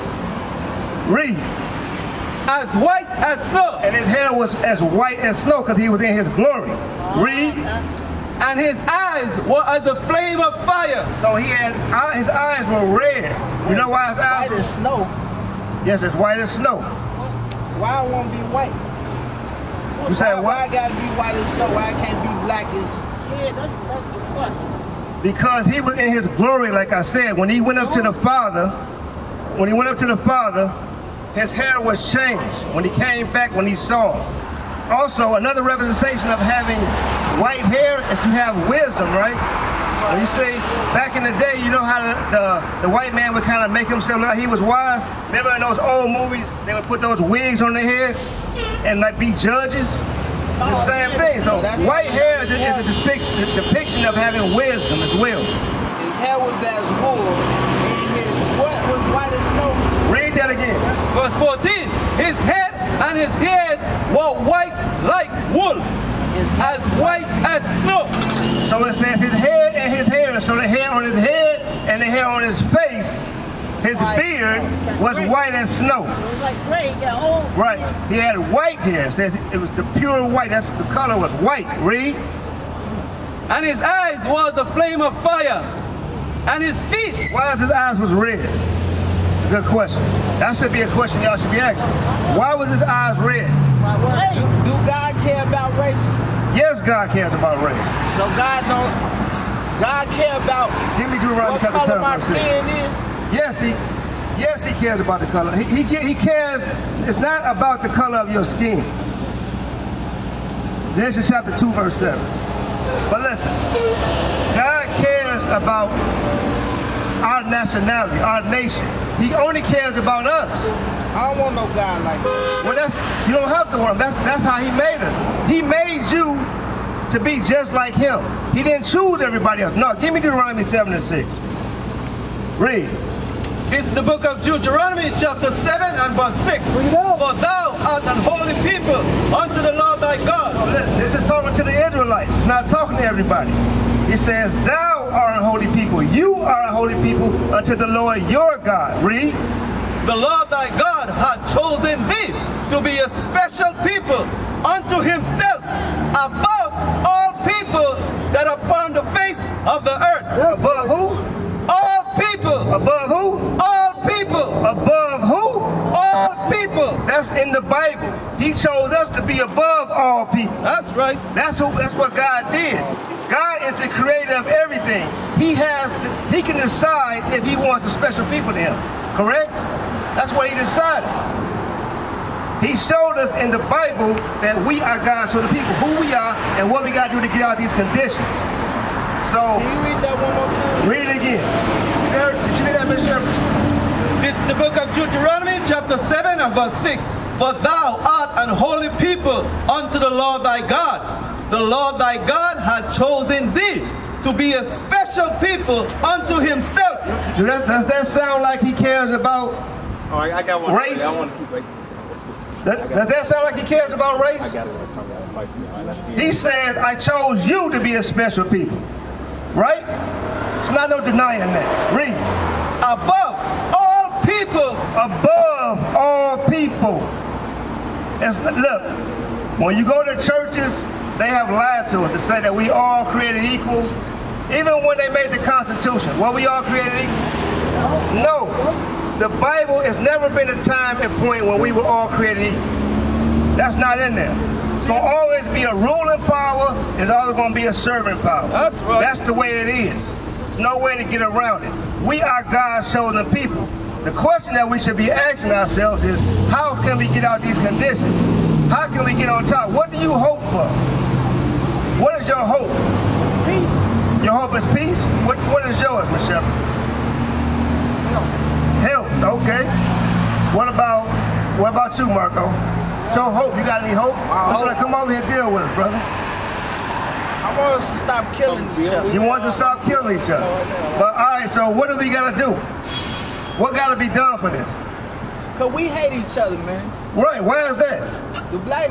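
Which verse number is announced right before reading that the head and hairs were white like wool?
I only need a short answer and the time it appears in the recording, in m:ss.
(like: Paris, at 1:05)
Verse 14, at 1:01.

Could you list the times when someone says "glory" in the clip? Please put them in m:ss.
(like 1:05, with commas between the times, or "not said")
0:06, 0:26.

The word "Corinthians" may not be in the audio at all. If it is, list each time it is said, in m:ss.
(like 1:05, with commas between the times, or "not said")
not said.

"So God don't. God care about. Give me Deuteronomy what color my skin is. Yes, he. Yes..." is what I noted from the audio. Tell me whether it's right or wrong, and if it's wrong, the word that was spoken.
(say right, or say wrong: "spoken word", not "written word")
right.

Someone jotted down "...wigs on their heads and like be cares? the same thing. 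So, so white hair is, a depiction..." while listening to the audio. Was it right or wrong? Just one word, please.
wrong.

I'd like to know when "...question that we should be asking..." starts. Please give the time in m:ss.
4:14.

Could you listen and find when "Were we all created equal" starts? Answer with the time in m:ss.
3:56.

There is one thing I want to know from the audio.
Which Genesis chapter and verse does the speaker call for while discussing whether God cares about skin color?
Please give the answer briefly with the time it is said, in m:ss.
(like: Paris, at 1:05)
Genesis 2:7, at 1:50.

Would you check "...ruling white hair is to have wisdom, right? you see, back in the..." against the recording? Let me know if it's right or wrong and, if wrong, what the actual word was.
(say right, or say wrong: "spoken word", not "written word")
wrong: "having", not "ruling".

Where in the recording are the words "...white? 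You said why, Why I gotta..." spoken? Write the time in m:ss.
0:18.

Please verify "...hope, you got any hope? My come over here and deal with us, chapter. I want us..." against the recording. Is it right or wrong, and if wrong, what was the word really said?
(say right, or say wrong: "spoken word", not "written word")
wrong: "brother", not "chapter".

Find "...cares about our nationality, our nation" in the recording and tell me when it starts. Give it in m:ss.
1:55.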